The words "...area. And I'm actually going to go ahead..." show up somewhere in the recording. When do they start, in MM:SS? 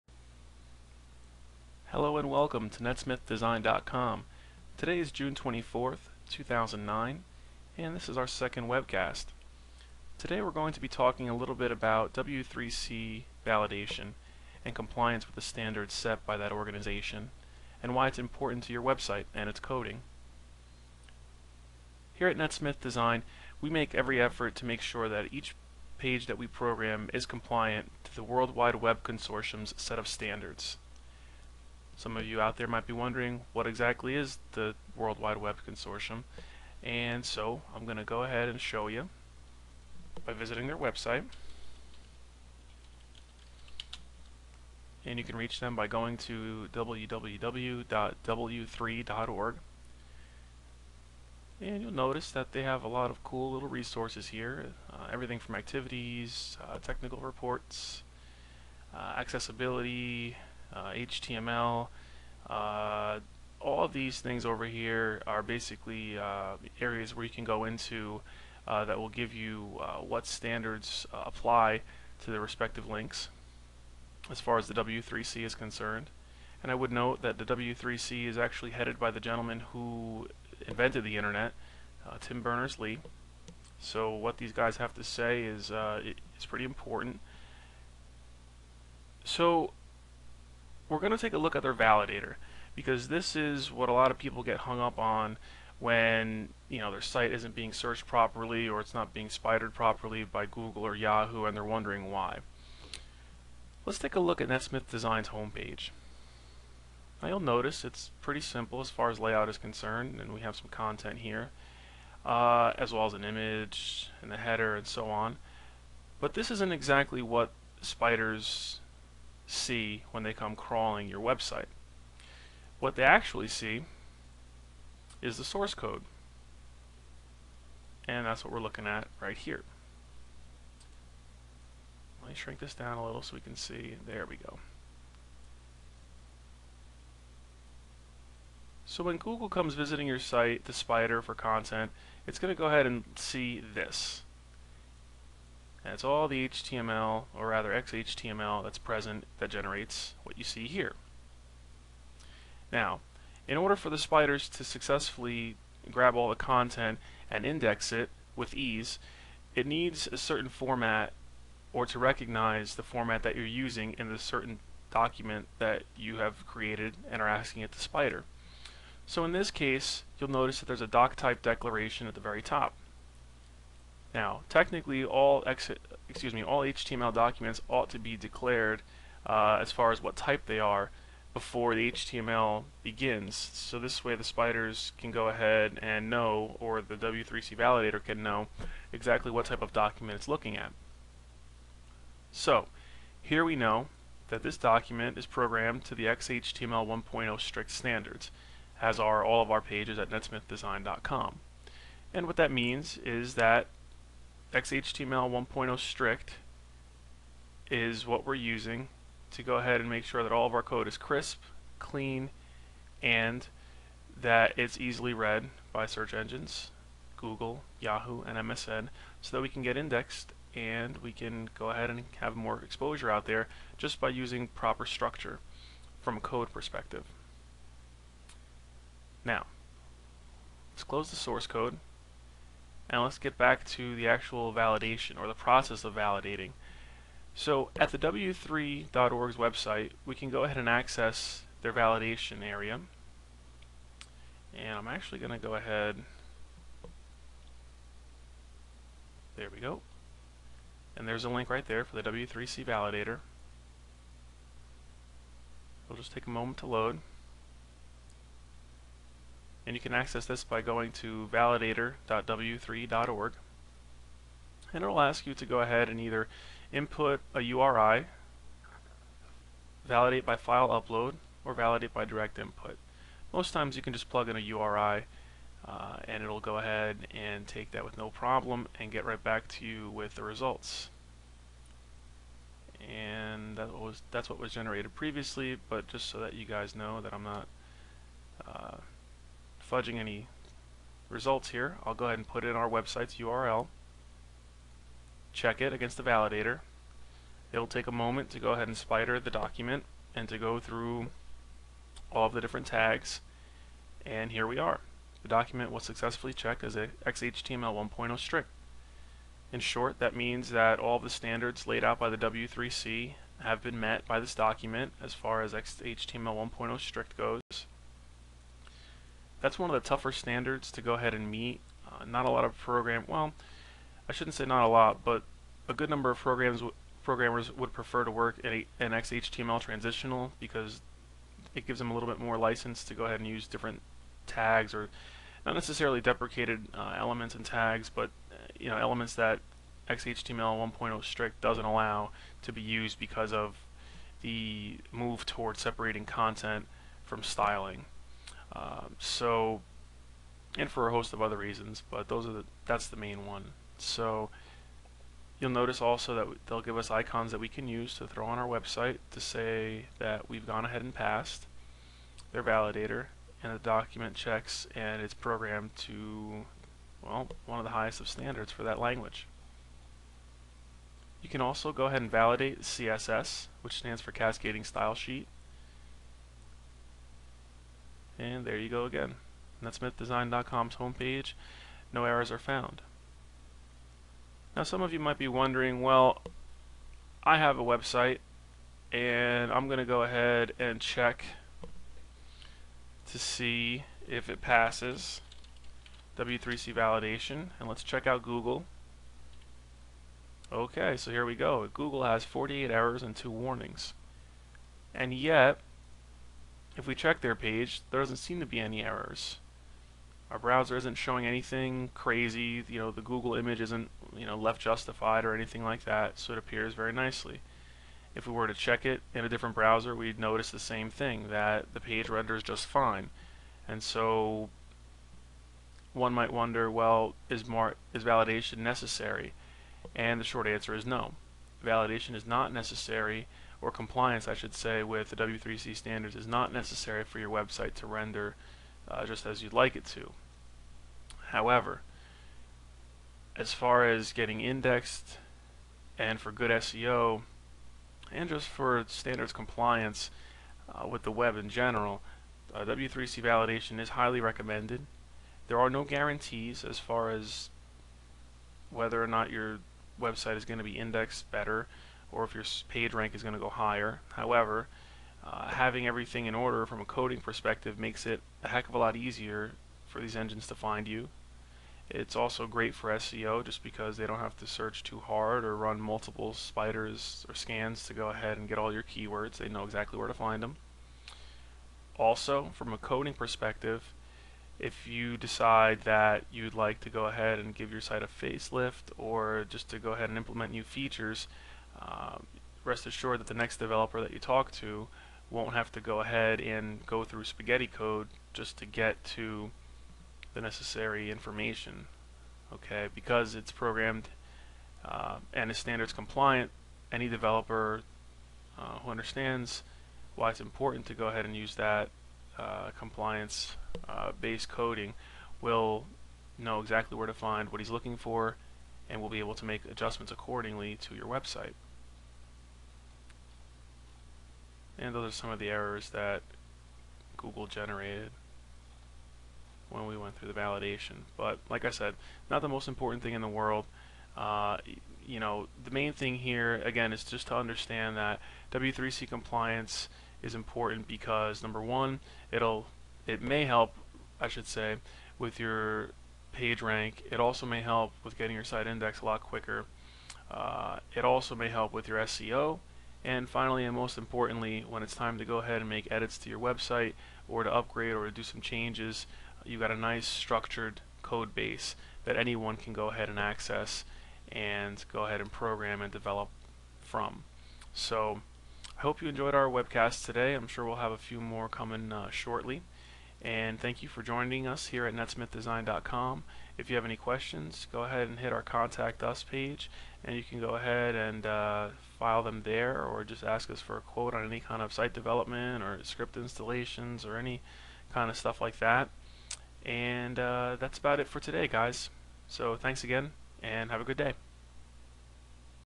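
04:02.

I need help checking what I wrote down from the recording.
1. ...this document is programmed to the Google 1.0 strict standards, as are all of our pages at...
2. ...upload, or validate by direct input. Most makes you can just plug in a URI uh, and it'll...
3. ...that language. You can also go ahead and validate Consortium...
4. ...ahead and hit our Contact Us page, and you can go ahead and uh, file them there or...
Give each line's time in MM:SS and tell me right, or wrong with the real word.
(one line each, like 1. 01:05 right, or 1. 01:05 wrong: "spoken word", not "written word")
1. 03:14 wrong: "XHTML", not "Google"
2. 04:30 wrong: "times", not "makes"
3. 06:08 wrong: "CSS", not "Consortium"
4. 09:37 right.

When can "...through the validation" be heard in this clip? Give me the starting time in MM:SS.
08:50.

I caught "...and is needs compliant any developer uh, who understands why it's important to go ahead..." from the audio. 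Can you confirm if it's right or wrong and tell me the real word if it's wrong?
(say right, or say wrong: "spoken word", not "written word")
wrong: "standards", not "needs".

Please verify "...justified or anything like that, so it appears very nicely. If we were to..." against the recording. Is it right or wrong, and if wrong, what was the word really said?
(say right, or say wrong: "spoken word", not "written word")
right.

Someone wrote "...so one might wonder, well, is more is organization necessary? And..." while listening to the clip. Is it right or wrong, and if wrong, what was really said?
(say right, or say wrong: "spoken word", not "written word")
wrong: "validation", not "organization".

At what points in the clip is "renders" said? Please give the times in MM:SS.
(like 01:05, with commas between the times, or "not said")
07:02, 07:17.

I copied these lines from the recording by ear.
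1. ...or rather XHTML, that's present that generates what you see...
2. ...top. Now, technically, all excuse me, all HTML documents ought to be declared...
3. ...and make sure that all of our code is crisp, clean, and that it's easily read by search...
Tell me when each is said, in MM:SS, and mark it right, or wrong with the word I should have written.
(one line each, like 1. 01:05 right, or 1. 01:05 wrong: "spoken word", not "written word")
1. 02:27 right
2. 02:52 right
3. 03:29 right.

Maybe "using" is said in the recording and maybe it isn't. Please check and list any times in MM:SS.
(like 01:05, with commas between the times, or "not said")
02:43, 03:28, 03:44.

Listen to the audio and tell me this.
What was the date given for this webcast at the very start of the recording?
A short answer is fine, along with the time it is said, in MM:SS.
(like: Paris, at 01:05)
June 24th, 2009, at 00:05.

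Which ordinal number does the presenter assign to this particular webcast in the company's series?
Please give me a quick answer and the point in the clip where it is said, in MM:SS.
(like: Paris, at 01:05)
second, at 00:08.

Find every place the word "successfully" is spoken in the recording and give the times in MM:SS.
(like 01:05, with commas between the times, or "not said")
02:34, 05:05.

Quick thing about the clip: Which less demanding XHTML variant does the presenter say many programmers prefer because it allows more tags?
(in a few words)
XHTML transitional.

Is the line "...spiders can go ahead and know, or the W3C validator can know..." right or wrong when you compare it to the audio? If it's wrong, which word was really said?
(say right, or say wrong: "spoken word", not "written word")
right.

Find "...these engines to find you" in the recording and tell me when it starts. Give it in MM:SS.
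07:50.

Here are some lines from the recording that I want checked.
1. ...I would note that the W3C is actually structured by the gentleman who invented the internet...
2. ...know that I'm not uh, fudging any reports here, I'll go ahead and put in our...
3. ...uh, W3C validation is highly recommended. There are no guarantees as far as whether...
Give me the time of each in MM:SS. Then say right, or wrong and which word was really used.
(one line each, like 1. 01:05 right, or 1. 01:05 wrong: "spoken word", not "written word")
1. 01:16 wrong: "headed", not "structured"
2. 04:46 wrong: "results", not "reports"
3. 07:32 right.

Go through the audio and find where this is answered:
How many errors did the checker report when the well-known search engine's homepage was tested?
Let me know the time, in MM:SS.
06:42.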